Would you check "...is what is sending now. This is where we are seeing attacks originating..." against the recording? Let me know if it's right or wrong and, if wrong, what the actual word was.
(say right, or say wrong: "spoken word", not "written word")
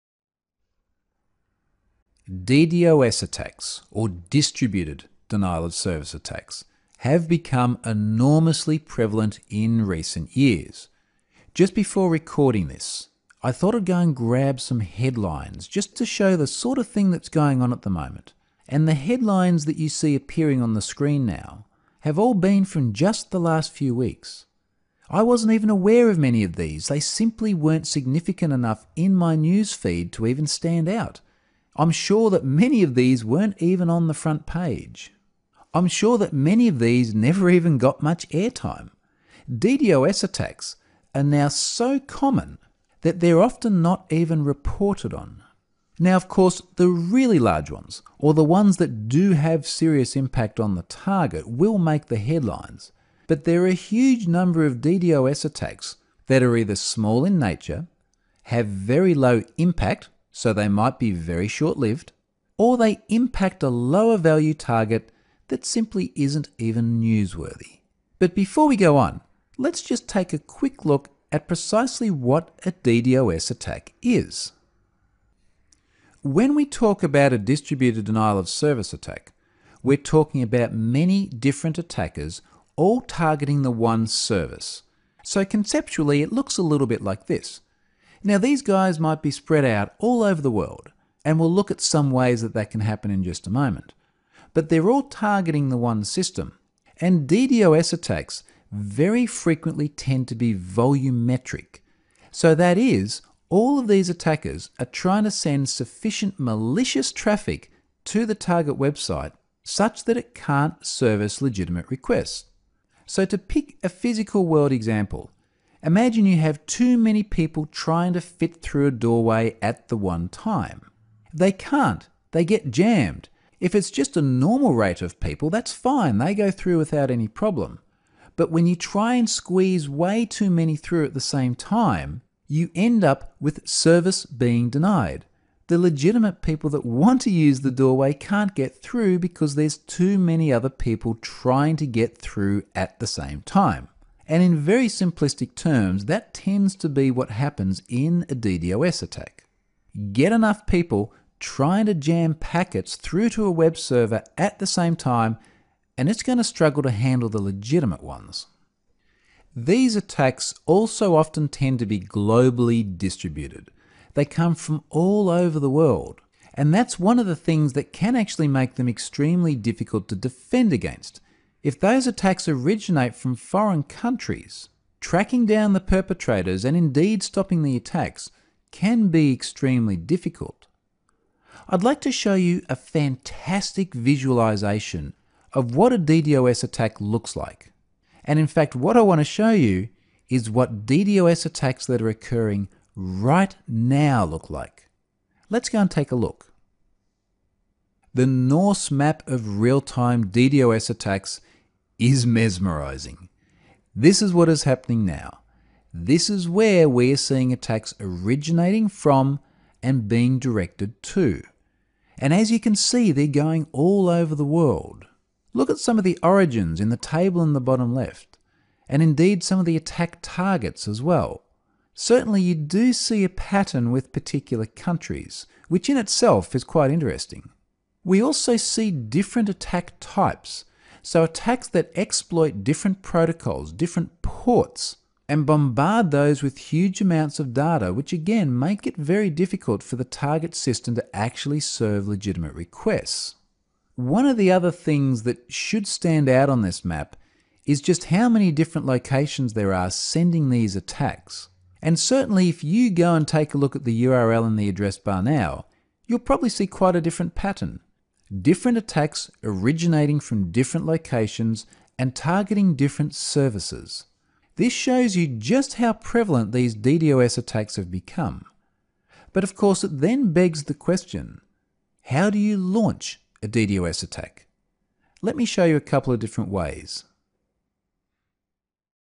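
wrong: "happening", not "sending".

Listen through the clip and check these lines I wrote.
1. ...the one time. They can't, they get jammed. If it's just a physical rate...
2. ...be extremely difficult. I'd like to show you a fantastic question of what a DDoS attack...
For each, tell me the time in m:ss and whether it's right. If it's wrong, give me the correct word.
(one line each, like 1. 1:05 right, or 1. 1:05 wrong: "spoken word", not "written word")
1. 1:59 wrong: "normal", not "physical"
2. 2:59 wrong: "visualization", not "question".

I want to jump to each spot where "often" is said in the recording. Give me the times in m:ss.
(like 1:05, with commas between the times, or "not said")
0:43, 2:41.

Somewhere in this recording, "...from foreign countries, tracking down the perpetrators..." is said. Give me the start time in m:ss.
2:53.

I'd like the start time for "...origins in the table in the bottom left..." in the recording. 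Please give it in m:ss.
3:36.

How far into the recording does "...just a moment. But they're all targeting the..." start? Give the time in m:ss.
1:33.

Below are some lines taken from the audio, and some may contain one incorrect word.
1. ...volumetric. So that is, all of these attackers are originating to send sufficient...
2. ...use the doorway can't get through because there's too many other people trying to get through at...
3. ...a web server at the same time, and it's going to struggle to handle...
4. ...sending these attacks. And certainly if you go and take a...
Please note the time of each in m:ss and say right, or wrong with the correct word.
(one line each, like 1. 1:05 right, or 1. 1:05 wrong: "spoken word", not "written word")
1. 1:40 wrong: "trying", not "originating"
2. 2:17 right
3. 2:33 right
4. 4:09 right.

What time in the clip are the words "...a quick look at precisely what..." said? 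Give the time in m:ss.
1:10.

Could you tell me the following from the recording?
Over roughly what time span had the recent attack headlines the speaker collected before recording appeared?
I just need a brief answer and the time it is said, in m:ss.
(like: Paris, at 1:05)
the last few weeks, at 0:22.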